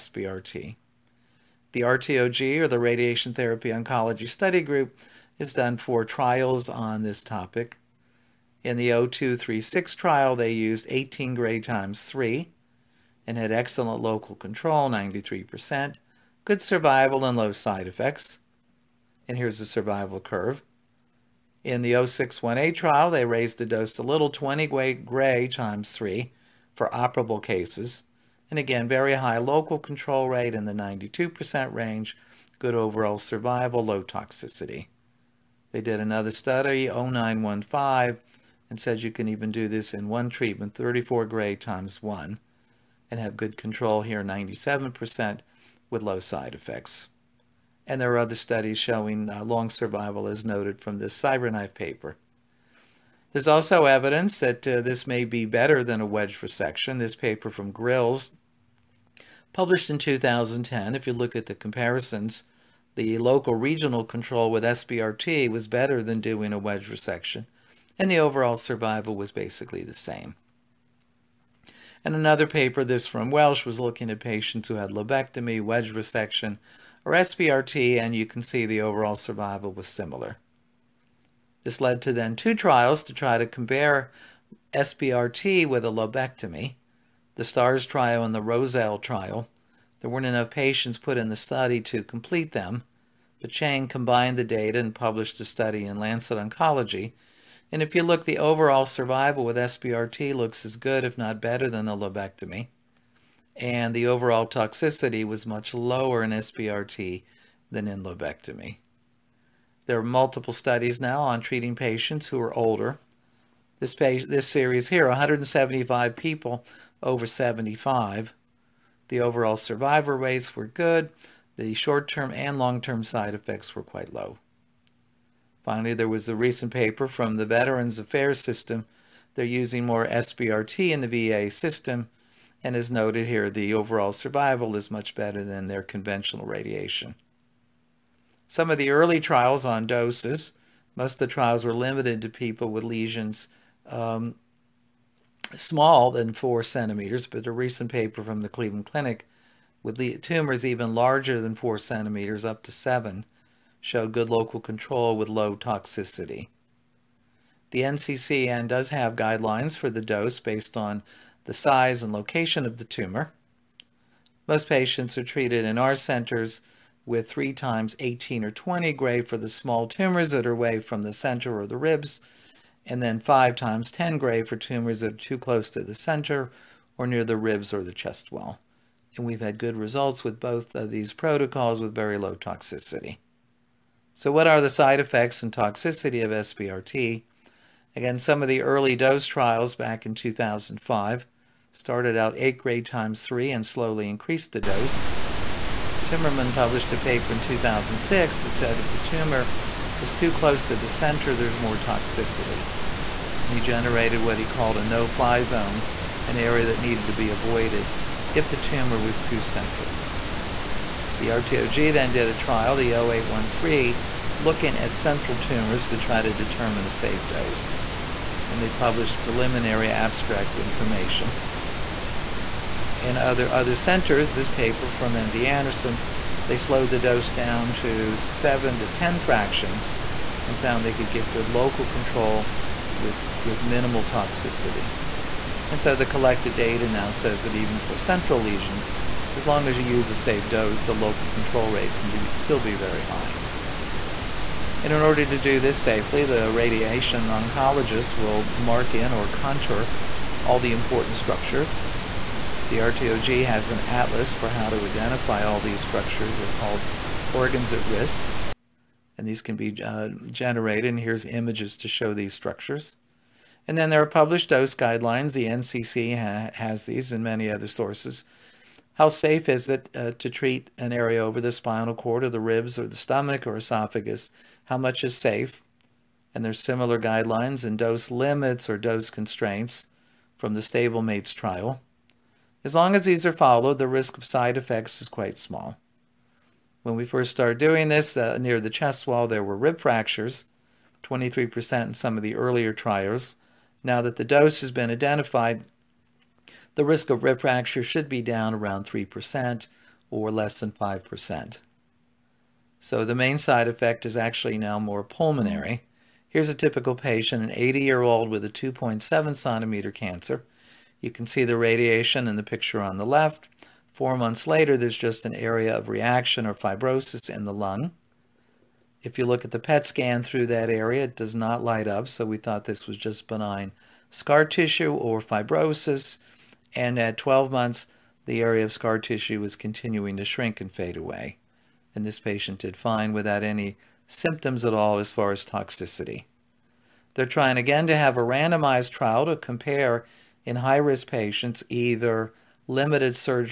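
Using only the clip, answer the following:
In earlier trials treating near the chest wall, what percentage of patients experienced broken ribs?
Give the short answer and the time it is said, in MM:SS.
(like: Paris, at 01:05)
23%, at 04:51.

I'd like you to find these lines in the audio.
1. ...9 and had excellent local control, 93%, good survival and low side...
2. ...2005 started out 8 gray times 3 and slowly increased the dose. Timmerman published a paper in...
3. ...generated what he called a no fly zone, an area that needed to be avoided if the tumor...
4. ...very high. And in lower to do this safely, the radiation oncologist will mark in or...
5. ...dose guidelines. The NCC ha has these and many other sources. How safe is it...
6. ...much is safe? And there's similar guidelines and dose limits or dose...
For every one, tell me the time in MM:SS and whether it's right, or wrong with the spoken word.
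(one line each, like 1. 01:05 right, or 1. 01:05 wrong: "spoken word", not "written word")
1. 00:12 wrong: "3", not "9"
2. 03:10 right
3. 03:23 right
4. 04:02 wrong: "order", not "lower"
5. 04:24 right
6. 04:34 right.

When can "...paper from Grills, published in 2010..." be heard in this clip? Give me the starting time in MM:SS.
00:57.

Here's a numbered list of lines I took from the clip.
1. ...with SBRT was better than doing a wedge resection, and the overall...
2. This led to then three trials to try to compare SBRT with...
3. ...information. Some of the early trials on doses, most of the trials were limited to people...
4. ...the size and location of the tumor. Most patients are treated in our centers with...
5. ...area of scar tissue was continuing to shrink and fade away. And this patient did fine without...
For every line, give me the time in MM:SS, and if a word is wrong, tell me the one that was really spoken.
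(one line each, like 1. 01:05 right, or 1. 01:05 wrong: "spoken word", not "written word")
1. 01:04 right
2. 01:21 wrong: "two", not "three"
3. 02:16 wrong: "radiation", not "information"
4. 02:41 right
5. 05:28 right.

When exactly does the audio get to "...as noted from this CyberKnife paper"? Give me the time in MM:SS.
00:50.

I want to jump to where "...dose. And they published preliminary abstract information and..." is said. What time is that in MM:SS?
03:37.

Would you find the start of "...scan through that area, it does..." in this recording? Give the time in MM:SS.
05:19.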